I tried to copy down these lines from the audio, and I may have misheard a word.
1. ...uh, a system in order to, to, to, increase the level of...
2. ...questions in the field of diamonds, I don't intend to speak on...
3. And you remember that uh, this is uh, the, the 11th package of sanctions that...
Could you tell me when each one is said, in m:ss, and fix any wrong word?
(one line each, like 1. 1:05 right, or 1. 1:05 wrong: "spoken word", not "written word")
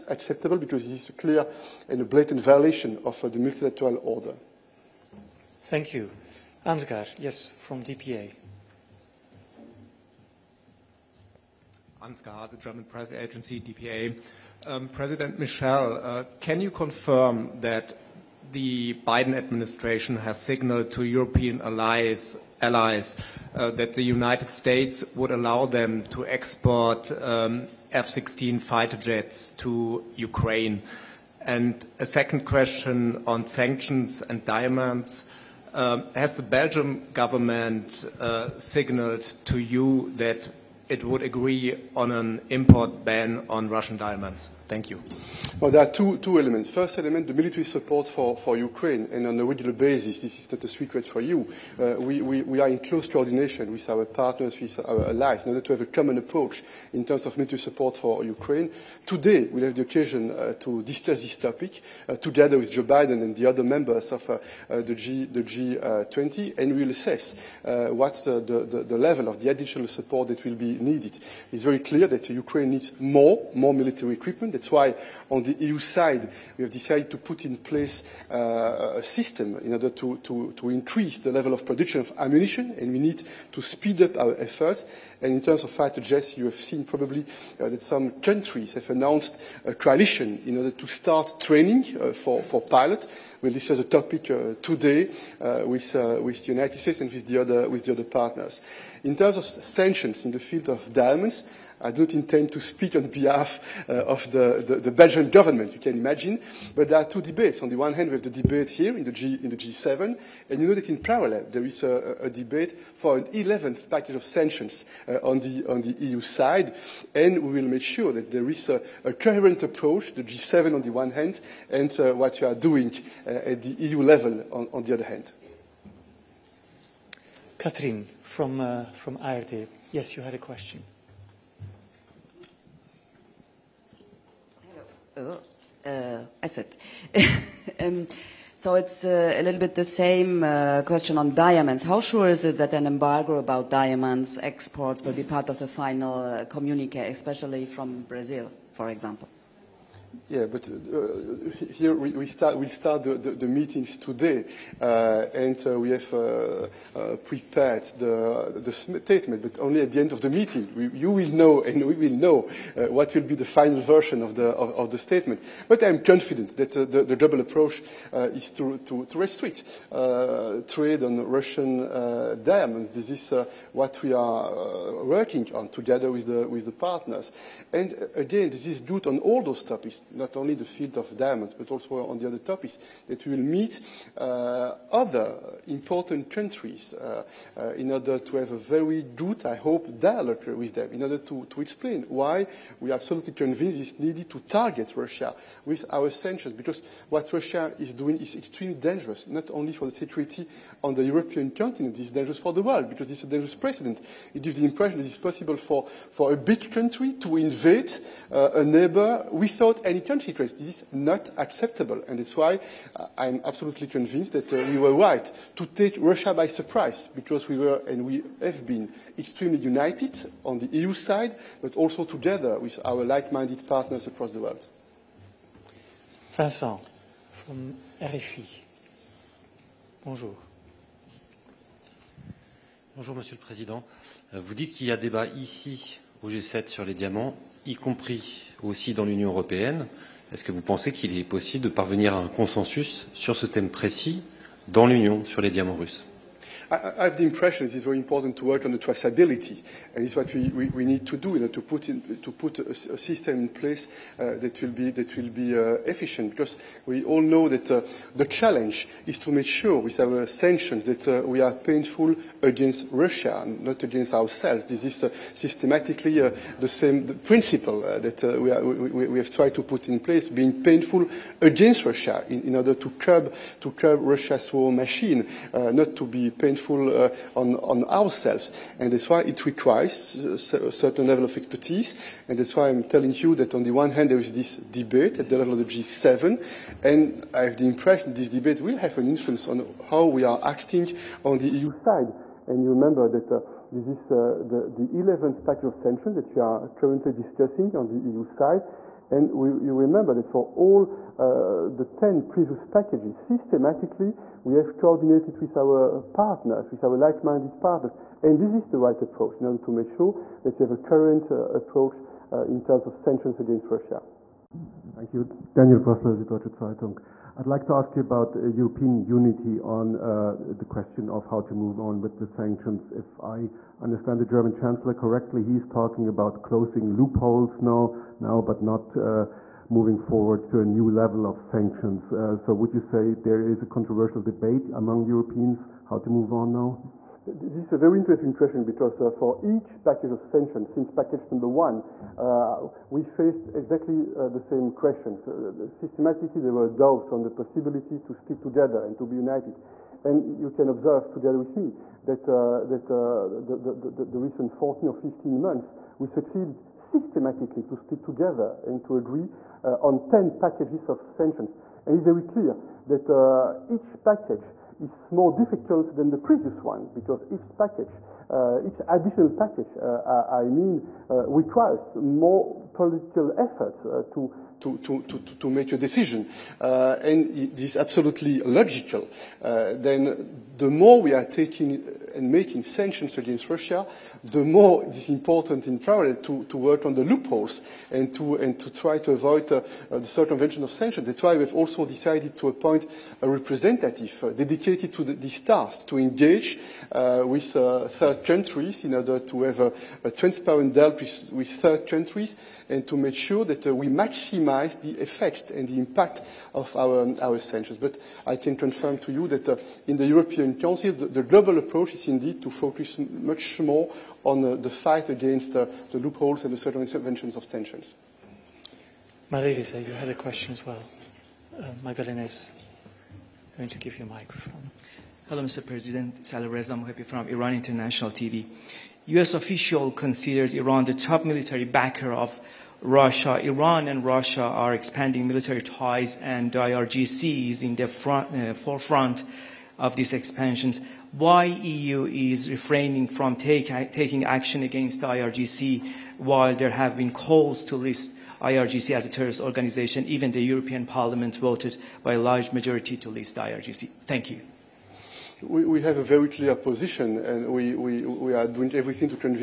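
1. 1:18 right
2. 1:39 wrong: "sanctions", not "questions"
3. 4:52 right.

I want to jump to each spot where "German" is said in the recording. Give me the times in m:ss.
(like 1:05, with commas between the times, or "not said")
0:12, 5:24.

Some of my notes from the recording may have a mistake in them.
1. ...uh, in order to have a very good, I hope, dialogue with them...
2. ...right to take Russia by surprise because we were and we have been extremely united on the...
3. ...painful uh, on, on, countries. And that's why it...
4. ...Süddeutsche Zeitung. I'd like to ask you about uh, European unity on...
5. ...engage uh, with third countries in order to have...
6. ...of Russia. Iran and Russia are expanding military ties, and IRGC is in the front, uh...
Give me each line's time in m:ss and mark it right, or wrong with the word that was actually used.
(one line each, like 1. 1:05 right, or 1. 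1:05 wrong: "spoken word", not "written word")
1. 3:07 right
2. 3:34 right
3. 4:36 wrong: "ourselves", not "countries"
4. 5:16 right
5. 6:35 right
6. 7:12 right.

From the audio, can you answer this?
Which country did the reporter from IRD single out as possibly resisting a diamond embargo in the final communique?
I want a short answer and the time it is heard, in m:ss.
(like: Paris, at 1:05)
Brazil, at 2:28.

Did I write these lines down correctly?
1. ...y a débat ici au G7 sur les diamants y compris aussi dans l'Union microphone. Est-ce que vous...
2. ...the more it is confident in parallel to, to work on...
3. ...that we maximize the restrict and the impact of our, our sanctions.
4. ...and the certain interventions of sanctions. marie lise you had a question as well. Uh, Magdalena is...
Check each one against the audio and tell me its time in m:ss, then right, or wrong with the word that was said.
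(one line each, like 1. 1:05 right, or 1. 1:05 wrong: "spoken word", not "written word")
1. 3:54 wrong: "européenne", not "microphone"
2. 6:24 wrong: "important", not "confident"
3. 6:43 wrong: "effect", not "restrict"
4. 6:56 right.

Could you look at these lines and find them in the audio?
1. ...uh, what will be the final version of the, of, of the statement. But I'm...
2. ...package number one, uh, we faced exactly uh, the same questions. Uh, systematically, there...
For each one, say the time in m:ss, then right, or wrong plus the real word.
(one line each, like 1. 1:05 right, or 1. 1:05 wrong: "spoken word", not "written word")
1. 2:42 right
2. 5:40 right.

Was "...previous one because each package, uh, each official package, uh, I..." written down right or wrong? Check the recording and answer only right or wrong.
wrong.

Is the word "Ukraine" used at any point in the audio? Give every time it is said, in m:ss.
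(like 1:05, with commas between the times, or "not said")
0:30, 0:48, 0:58, 1:12.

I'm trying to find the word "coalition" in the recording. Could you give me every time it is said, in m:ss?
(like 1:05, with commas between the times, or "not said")
1:29.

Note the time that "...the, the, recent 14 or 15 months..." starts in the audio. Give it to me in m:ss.
5:53.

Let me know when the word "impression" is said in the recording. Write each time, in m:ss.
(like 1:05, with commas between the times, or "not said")
3:24, 4:07, 4:47.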